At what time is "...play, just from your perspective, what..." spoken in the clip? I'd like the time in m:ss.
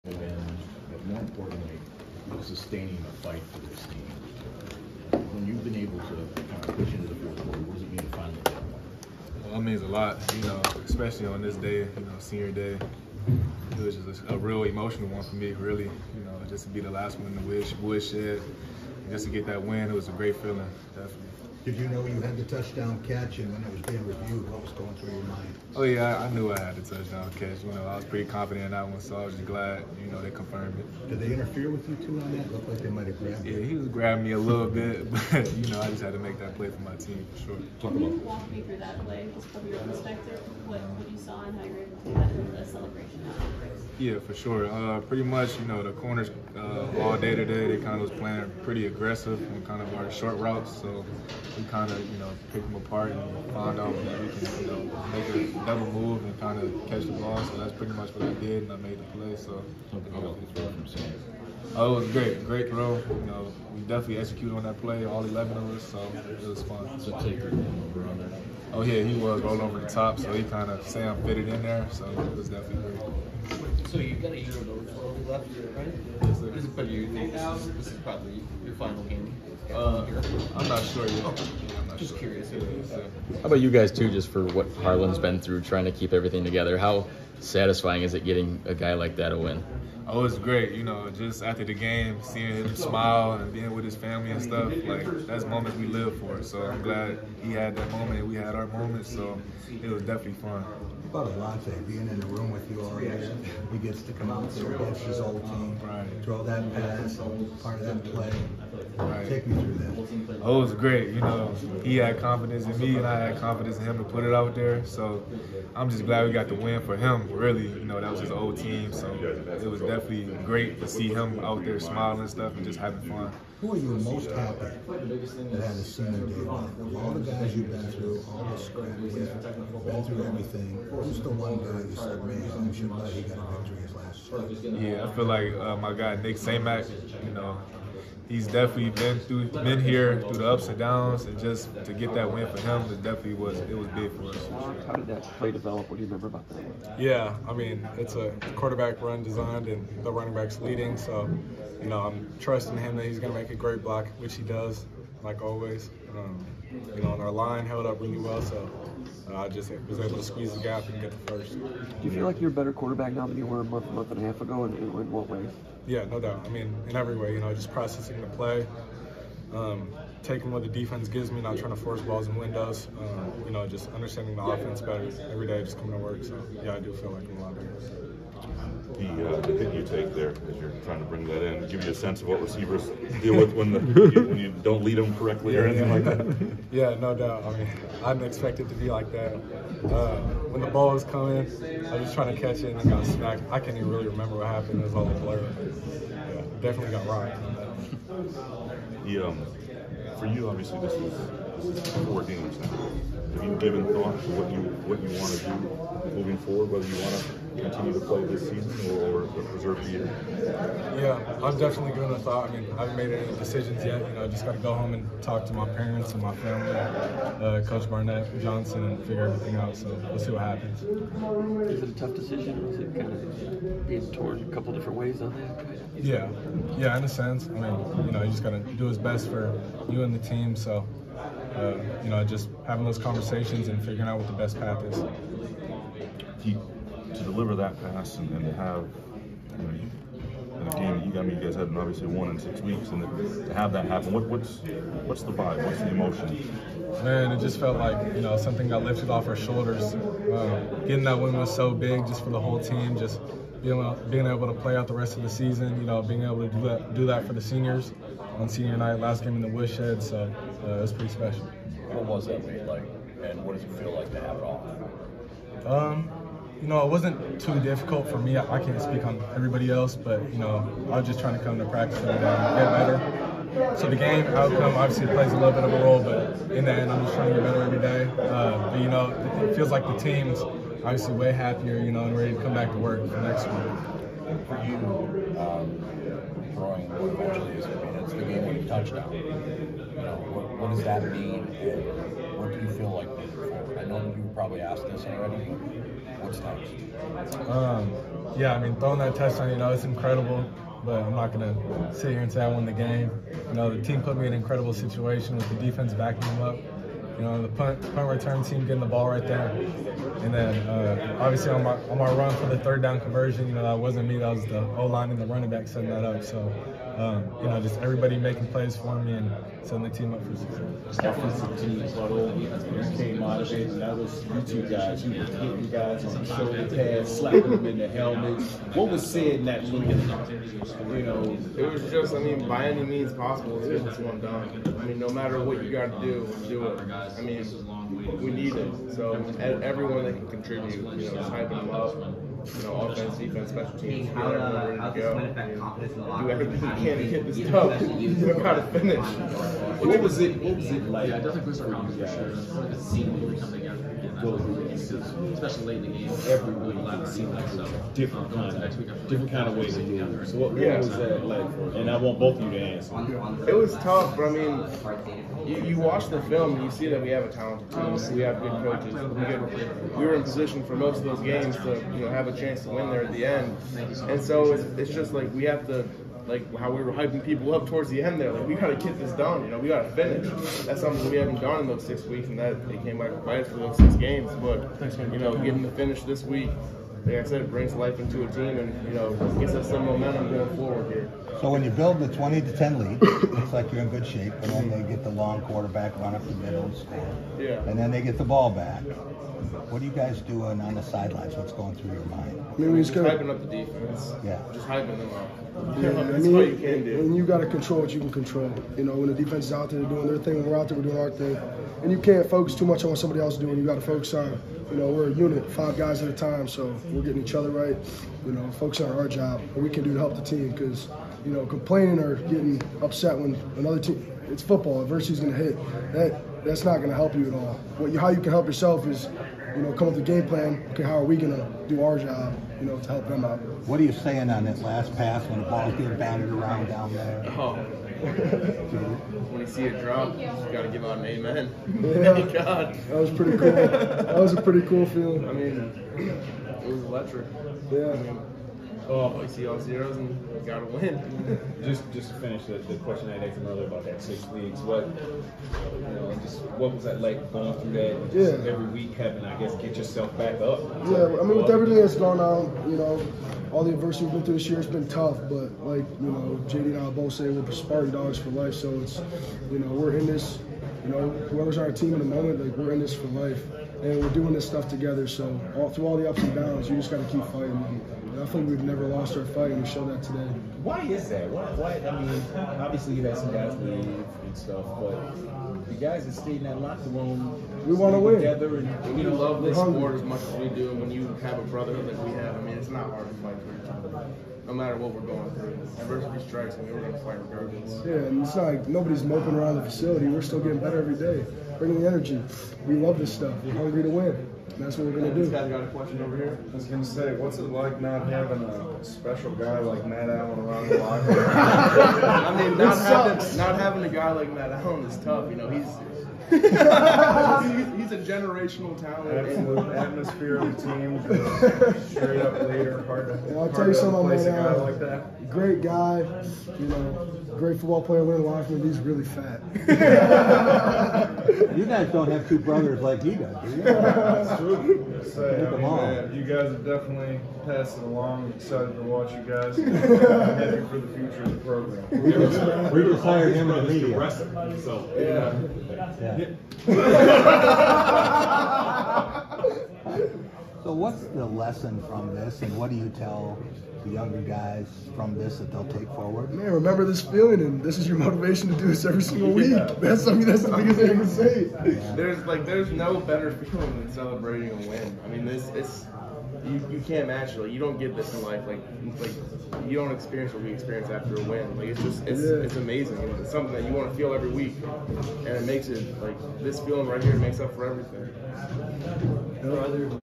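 0:39.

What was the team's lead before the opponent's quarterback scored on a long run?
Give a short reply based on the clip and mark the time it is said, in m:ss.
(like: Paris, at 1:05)
20 to 10, at 6:32.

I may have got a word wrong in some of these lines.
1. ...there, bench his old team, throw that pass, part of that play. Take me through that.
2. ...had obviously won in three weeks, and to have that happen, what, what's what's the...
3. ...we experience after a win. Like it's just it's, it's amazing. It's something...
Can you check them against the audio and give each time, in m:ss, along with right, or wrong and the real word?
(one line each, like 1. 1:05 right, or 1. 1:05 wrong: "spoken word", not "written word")
1. 1:44 right
2. 4:01 wrong: "six", not "three"
3. 9:30 right.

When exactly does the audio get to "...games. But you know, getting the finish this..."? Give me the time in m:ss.
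6:23.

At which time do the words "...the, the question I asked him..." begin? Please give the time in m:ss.
7:32.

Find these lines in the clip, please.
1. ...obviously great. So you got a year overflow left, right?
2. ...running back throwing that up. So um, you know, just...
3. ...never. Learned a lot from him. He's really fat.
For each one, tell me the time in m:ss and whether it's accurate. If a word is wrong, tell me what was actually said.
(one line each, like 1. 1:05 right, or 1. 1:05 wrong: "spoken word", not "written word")
1. 1:12 wrong: "definitely", not "obviously"
2. 5:15 wrong: "setting", not "throwing"
3. 8:47 wrong: "player", not "never".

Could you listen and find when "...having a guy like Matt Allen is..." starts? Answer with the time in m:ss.
8:33.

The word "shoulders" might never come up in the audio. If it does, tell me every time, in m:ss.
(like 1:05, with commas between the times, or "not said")
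4:09, 5:26.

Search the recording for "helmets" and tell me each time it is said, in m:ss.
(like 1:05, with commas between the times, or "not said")
5:27.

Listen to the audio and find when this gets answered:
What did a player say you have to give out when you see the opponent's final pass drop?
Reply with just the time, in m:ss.
7:20.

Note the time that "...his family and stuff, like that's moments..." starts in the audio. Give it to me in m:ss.
1:33.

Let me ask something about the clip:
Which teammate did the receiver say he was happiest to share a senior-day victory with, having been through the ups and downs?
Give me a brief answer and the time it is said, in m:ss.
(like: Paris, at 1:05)
Nick Samac, at 2:16.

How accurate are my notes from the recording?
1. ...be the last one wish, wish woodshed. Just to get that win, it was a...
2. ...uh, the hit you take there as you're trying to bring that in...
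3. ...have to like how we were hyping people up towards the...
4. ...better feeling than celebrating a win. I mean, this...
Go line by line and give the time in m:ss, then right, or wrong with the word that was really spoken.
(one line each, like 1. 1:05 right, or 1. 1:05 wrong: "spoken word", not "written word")
1. 0:16 right
2. 2:59 right
3. 6:15 right
4. 9:22 right.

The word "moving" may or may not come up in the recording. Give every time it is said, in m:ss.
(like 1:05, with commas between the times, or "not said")
3:26, 4:53.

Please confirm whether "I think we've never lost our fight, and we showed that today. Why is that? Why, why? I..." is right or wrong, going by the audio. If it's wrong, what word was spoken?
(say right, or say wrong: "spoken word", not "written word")
right.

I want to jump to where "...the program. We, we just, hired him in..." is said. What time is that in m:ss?
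9:01.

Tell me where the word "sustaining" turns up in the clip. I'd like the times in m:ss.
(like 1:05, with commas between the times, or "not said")
0:02.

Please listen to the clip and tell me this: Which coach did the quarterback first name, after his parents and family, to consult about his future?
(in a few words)
Coach Barnett.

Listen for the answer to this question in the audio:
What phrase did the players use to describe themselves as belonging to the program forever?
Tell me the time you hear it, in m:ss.
7:47.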